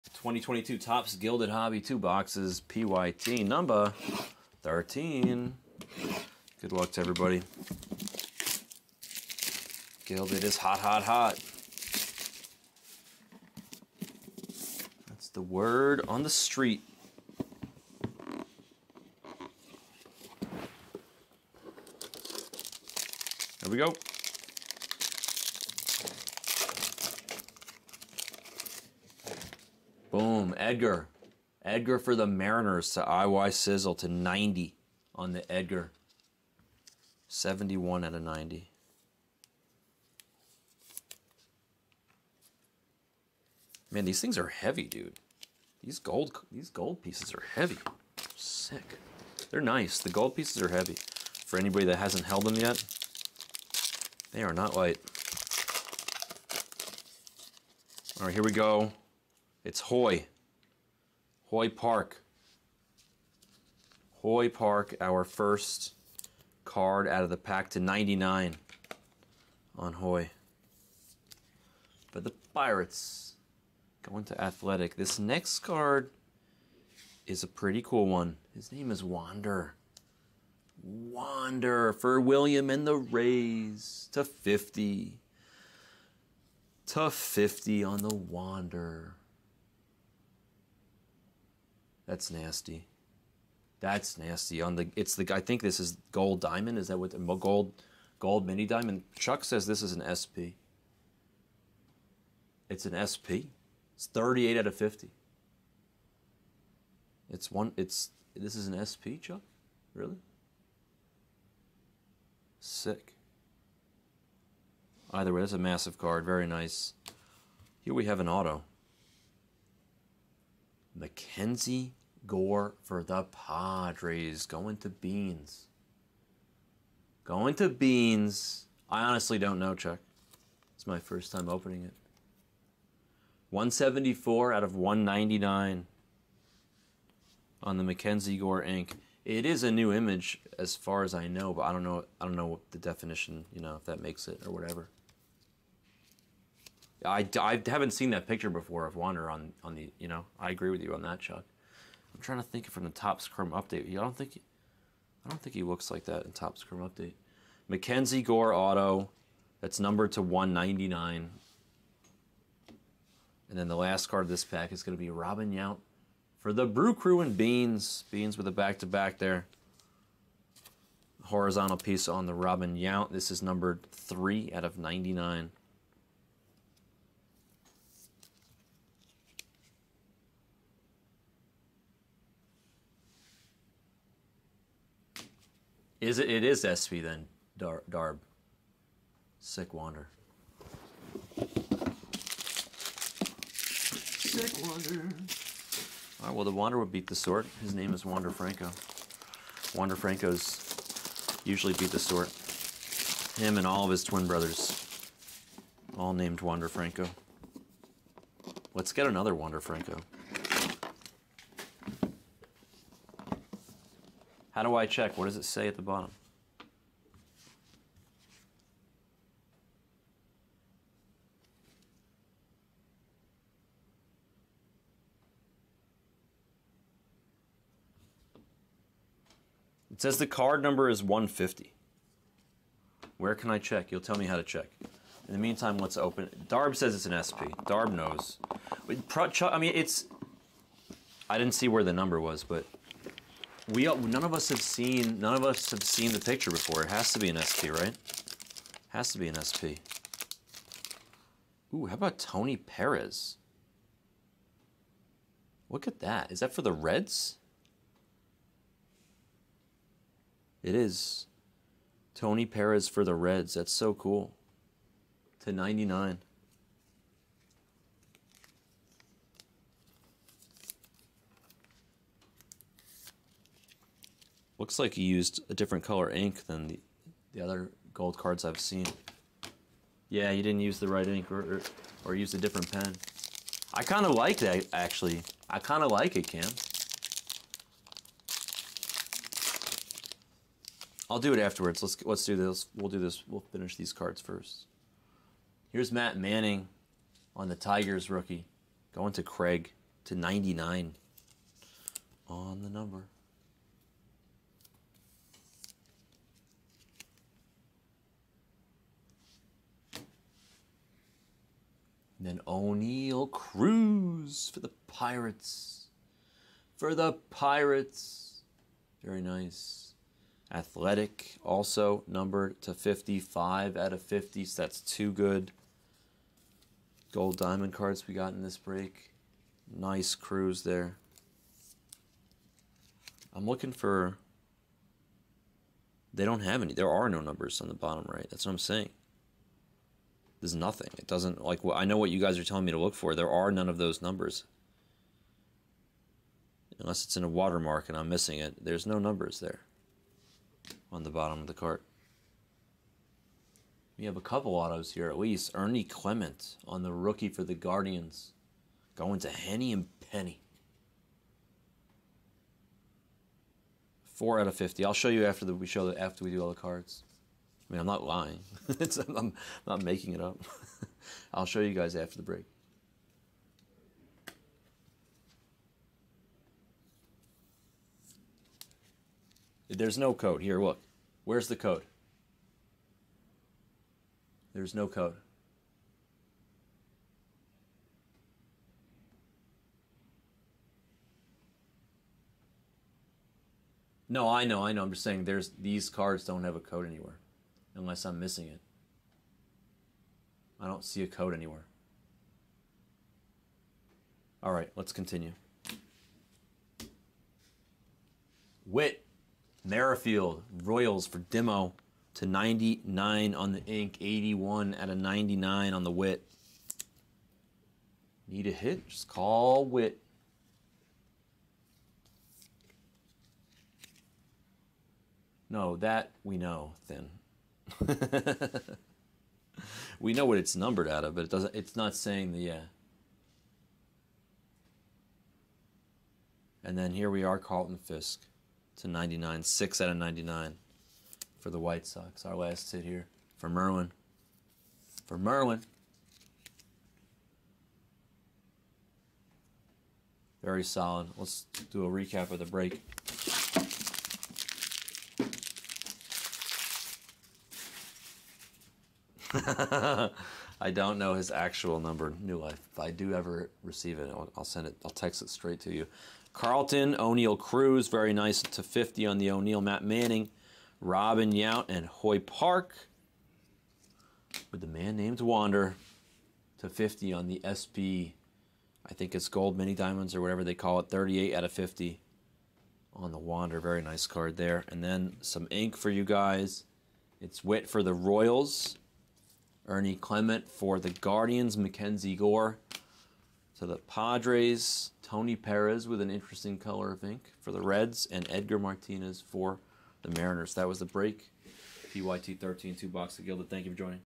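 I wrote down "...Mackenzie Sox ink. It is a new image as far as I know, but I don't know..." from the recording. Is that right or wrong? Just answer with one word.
wrong.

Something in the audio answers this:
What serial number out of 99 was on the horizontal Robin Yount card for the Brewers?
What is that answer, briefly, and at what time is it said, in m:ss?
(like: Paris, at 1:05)
3, at 2:53.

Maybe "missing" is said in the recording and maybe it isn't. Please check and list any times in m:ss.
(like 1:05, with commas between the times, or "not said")
5:48, 6:38.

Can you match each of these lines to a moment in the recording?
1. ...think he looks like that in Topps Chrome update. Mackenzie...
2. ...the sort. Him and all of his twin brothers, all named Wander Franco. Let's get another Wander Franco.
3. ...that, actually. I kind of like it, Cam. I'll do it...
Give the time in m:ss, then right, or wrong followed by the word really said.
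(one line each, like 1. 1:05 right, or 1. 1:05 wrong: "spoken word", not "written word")
1. 2:35 right
2. 3:21 right
3. 4:44 right.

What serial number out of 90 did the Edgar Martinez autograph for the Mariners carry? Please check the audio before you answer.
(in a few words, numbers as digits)
71.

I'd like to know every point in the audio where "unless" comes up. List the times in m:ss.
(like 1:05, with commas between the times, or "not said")
5:46, 6:37.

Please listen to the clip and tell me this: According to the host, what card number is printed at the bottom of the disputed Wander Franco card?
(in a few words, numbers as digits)
150.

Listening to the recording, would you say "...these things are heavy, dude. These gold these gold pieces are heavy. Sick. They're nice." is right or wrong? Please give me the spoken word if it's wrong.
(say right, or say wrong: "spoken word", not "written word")
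right.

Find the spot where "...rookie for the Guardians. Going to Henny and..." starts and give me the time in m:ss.
5:56.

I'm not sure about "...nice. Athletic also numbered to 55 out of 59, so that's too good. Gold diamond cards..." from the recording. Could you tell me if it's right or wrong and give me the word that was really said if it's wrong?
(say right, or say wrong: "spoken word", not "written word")
wrong: "50", not "59".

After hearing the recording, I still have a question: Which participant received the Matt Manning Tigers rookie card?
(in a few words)
Craig.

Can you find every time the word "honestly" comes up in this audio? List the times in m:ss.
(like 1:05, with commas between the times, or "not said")
2:09.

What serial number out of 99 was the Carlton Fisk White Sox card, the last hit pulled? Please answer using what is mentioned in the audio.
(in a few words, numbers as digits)
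6.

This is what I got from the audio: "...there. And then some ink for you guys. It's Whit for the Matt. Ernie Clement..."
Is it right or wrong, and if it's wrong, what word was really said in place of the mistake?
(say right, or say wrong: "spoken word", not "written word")
wrong: "Royals", not "Matt".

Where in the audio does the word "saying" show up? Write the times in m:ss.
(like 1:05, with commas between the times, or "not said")
5:38, 6:35, 7:11.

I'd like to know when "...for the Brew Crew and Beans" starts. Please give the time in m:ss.
2:46.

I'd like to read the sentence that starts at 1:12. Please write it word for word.
But the Pirates going to Athletic.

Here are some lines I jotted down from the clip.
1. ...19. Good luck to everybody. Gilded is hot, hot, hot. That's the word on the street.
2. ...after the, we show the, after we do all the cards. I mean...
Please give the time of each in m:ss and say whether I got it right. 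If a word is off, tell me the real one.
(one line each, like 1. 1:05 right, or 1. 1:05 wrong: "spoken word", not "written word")
1. 0:04 wrong: "13", not "19"
2. 6:05 right.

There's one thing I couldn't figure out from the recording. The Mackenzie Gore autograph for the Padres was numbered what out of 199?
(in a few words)
174.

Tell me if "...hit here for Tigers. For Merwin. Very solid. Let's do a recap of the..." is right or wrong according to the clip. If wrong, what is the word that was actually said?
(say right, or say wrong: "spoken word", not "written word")
wrong: "Merwin", not "Tigers".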